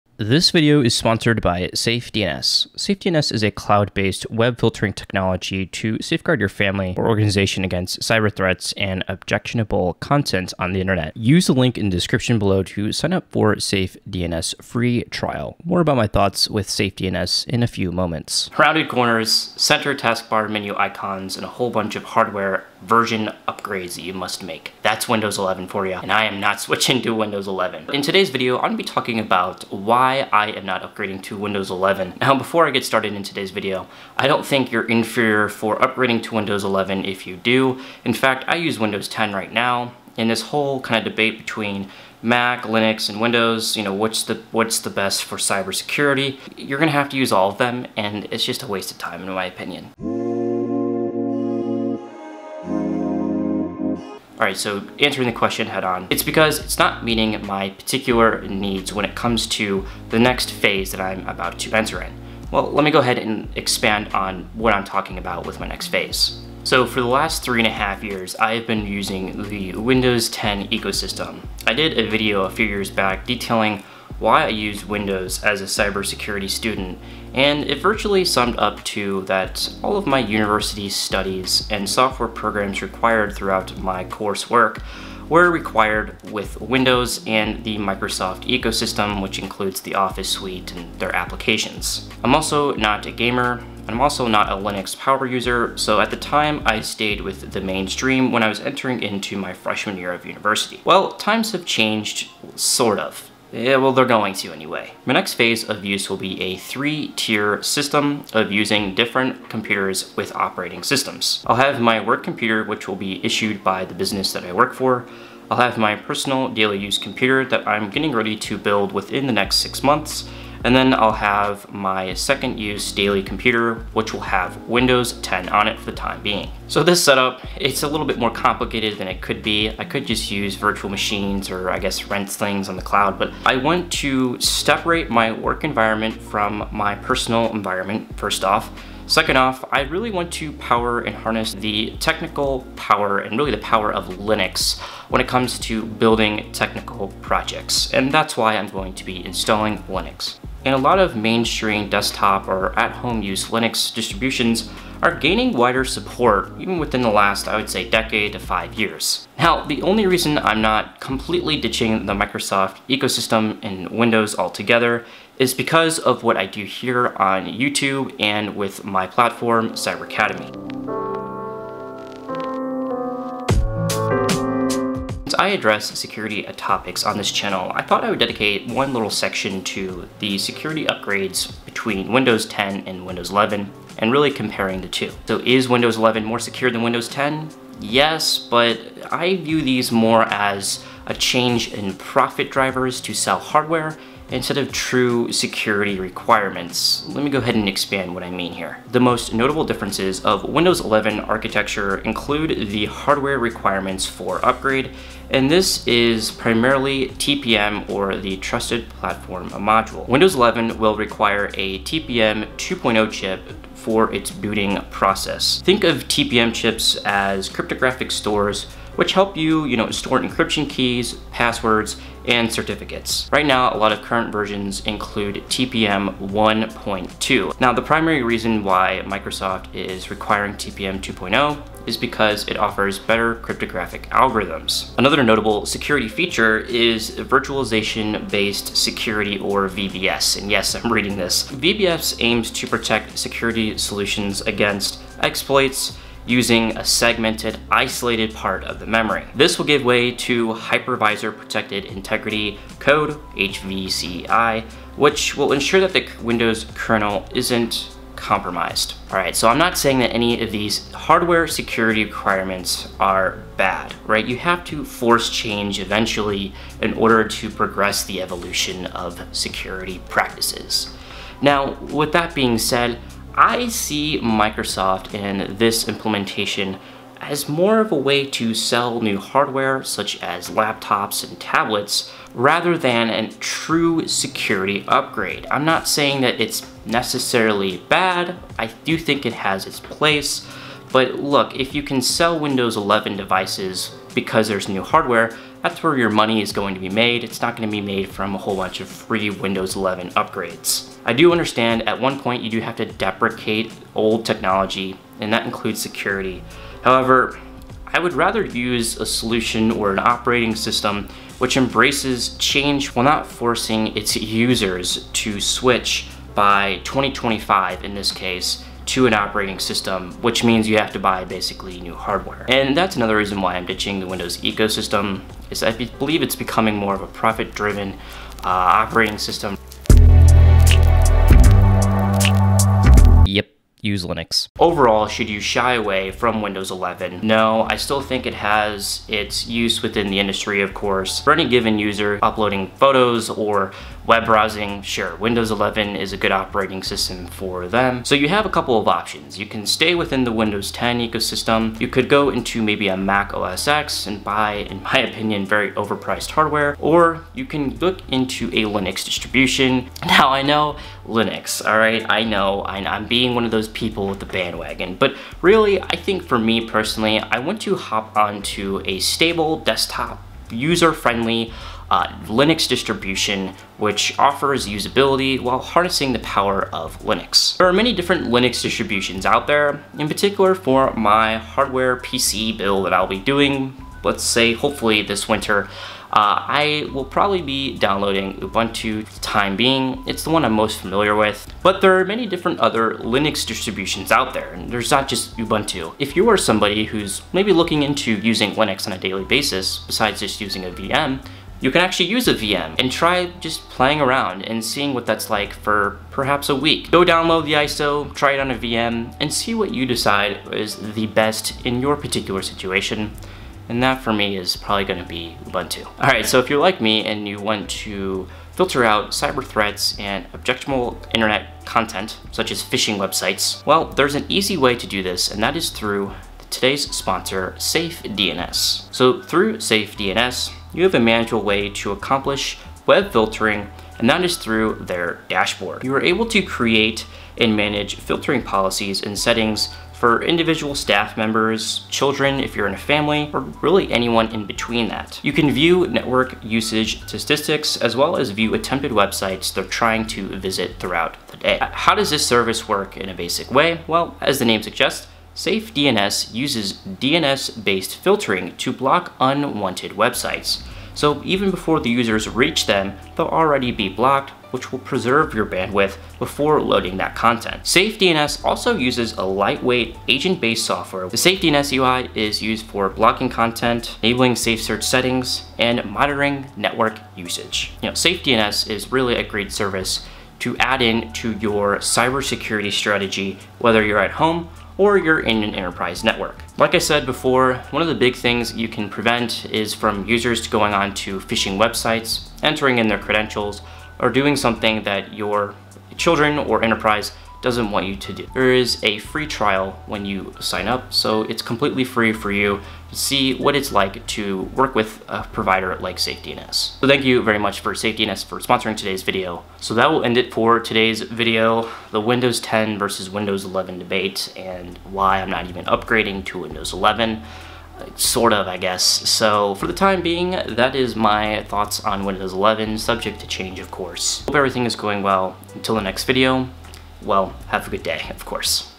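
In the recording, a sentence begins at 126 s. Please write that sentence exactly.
So this setup, it's a little bit more complicated than it could be.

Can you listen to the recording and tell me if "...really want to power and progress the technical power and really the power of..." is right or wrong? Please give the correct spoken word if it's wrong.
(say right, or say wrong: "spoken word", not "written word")
wrong: "harness", not "progress".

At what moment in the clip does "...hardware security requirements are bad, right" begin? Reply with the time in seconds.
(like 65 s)
260 s.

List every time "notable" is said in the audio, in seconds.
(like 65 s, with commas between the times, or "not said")
199 s, 235 s.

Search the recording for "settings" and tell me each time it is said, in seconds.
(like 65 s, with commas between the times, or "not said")
439 s, 474 s.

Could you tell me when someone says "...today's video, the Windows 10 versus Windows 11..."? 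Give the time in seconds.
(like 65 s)
510 s.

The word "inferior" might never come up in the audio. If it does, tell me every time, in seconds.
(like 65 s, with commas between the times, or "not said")
34 s.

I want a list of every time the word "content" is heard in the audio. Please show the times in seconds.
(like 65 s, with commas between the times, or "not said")
9 s, 421 s, 467 s, 473 s.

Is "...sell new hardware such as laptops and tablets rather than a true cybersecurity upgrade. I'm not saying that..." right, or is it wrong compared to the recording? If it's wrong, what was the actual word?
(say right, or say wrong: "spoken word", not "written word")
wrong: "security", not "cybersecurity".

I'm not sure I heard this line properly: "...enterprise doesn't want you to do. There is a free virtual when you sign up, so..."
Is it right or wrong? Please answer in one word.
wrong.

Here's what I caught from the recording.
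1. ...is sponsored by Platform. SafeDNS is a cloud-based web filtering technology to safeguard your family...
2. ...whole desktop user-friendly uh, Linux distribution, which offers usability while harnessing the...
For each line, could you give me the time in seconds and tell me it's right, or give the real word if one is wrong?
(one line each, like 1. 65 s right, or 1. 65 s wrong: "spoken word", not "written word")
1. 0 s wrong: "SafeDNS", not "Platform"
2. 368 s wrong: "stable", not "whole".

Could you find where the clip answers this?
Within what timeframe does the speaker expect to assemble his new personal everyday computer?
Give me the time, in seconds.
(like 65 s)
119 s.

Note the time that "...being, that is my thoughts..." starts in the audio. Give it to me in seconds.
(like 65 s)
520 s.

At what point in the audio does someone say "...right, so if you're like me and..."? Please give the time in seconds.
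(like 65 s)
416 s.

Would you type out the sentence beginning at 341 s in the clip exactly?
For any given user uploading photos or Web browsing, sure, Windows 11 is a good operating system for them.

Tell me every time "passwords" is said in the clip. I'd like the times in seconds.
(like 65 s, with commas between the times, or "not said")
221 s.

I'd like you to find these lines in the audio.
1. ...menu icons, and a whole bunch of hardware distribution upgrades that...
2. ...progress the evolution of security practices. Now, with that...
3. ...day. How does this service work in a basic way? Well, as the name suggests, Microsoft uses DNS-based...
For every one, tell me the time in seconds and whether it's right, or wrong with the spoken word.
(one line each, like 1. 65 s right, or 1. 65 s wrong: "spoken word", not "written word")
1. 20 s wrong: "version", not "distribution"
2. 267 s right
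3. 451 s wrong: "SafeDNS", not "Microsoft".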